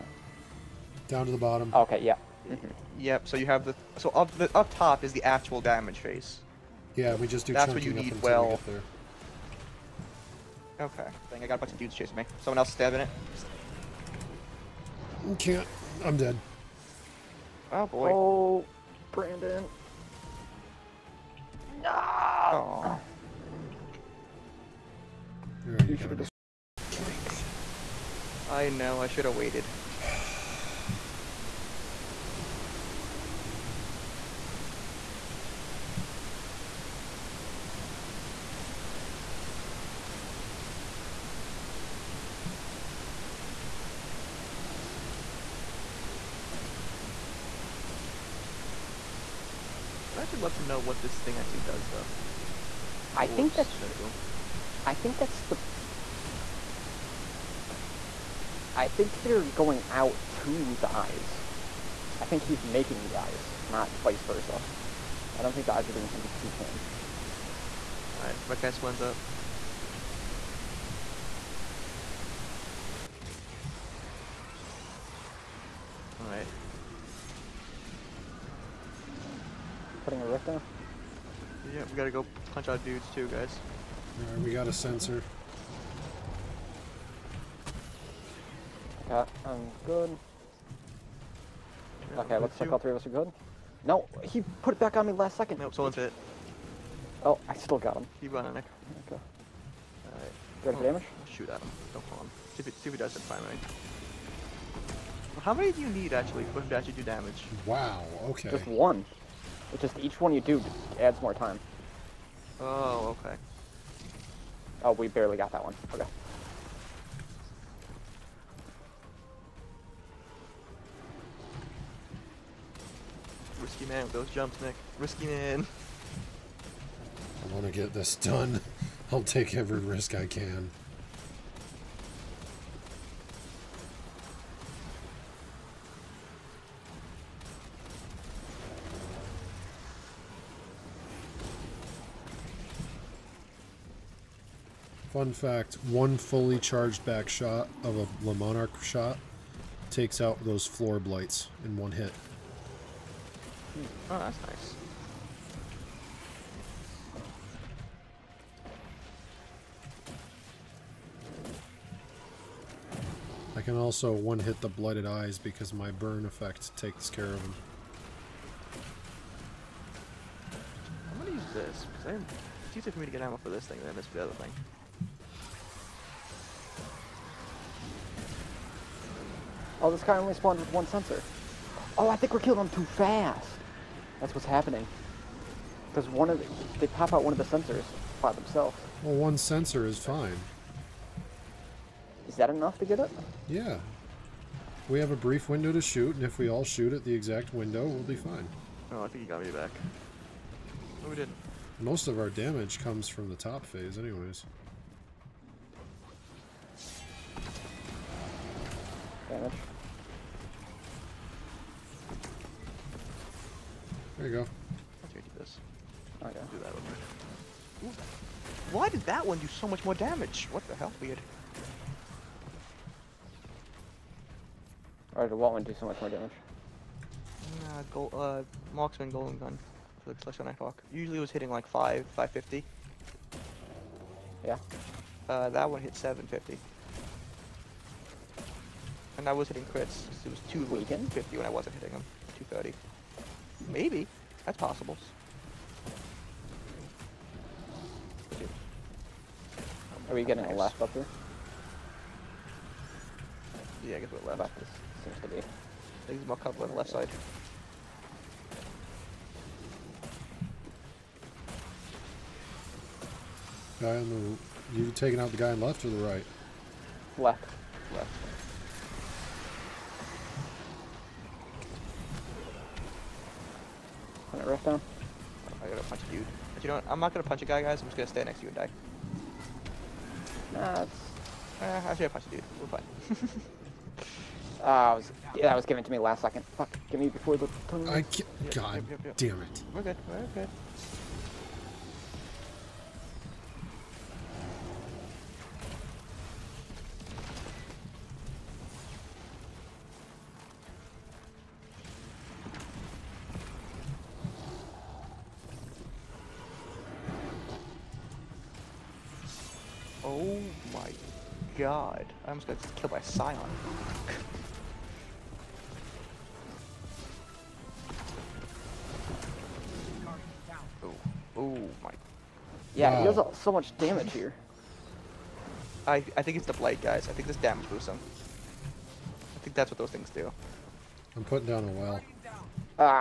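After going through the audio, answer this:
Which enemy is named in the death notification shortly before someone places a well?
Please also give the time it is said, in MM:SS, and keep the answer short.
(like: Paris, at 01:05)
Scion, at 05:12.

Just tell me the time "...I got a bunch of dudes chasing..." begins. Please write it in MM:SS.
00:11.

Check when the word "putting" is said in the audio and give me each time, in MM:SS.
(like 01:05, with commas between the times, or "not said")
01:20, 05:31.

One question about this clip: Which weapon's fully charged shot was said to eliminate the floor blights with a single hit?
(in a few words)
Le Monarque.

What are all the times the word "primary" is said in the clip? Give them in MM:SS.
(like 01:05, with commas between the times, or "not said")
01:43.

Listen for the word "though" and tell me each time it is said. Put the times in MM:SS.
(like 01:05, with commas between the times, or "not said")
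00:51.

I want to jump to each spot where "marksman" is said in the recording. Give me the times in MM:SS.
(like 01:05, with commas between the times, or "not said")
03:48.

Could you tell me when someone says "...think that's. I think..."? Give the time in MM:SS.
00:53.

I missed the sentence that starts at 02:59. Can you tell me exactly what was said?
Oh, this guy only spawned with one sensor.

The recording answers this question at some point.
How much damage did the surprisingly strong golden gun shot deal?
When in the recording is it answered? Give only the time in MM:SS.
03:55.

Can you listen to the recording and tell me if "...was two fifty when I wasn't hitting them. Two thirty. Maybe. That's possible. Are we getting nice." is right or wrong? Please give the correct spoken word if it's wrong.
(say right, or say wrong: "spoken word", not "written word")
right.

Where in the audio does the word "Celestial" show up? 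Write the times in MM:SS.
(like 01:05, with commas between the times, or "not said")
03:50.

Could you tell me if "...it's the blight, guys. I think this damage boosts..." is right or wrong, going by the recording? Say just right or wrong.
right.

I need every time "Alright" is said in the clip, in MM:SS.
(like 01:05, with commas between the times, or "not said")
01:08, 01:16, 01:24, 01:40.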